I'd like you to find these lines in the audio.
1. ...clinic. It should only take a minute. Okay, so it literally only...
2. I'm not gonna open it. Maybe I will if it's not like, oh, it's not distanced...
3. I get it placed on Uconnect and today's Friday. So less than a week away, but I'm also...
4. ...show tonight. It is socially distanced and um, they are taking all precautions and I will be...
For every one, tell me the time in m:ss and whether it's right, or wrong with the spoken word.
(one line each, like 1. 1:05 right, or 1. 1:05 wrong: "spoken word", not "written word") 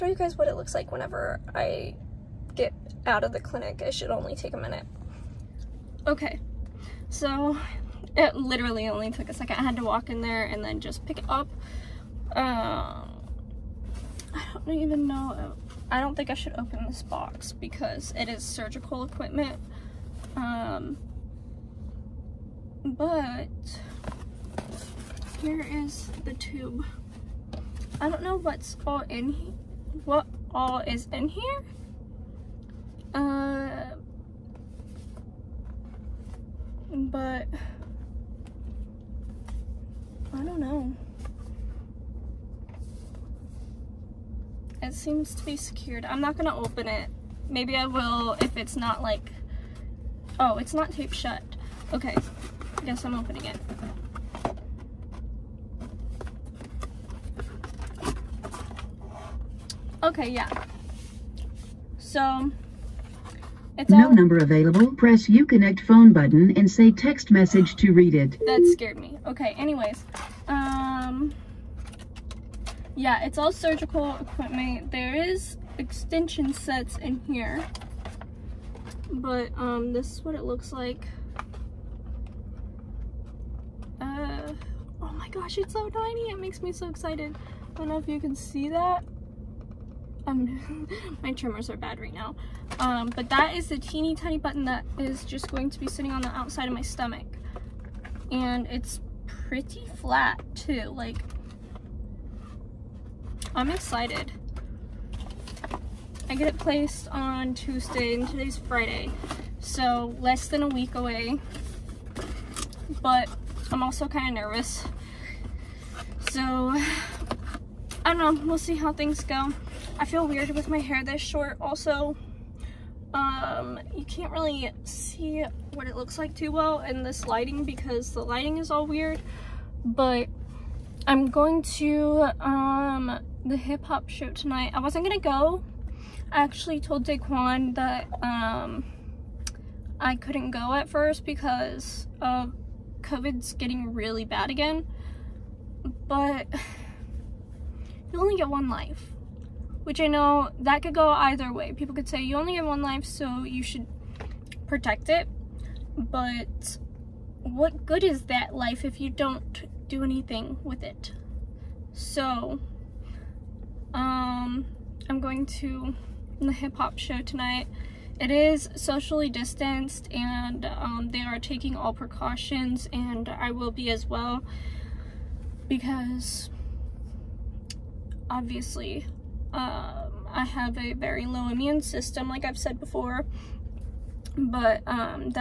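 1. 0:03 right
2. 0:46 wrong: "taped", not "distanced"
3. 1:46 wrong: "Tuesday", not "Uconnect"
4. 2:46 right.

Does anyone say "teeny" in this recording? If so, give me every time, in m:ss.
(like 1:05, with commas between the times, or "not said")
1:33.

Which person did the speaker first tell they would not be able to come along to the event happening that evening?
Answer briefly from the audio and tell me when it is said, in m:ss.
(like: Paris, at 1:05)
Daquan, at 2:17.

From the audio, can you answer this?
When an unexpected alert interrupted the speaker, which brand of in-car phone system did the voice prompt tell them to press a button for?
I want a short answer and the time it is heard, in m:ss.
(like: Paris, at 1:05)
Uconnect, at 1:05.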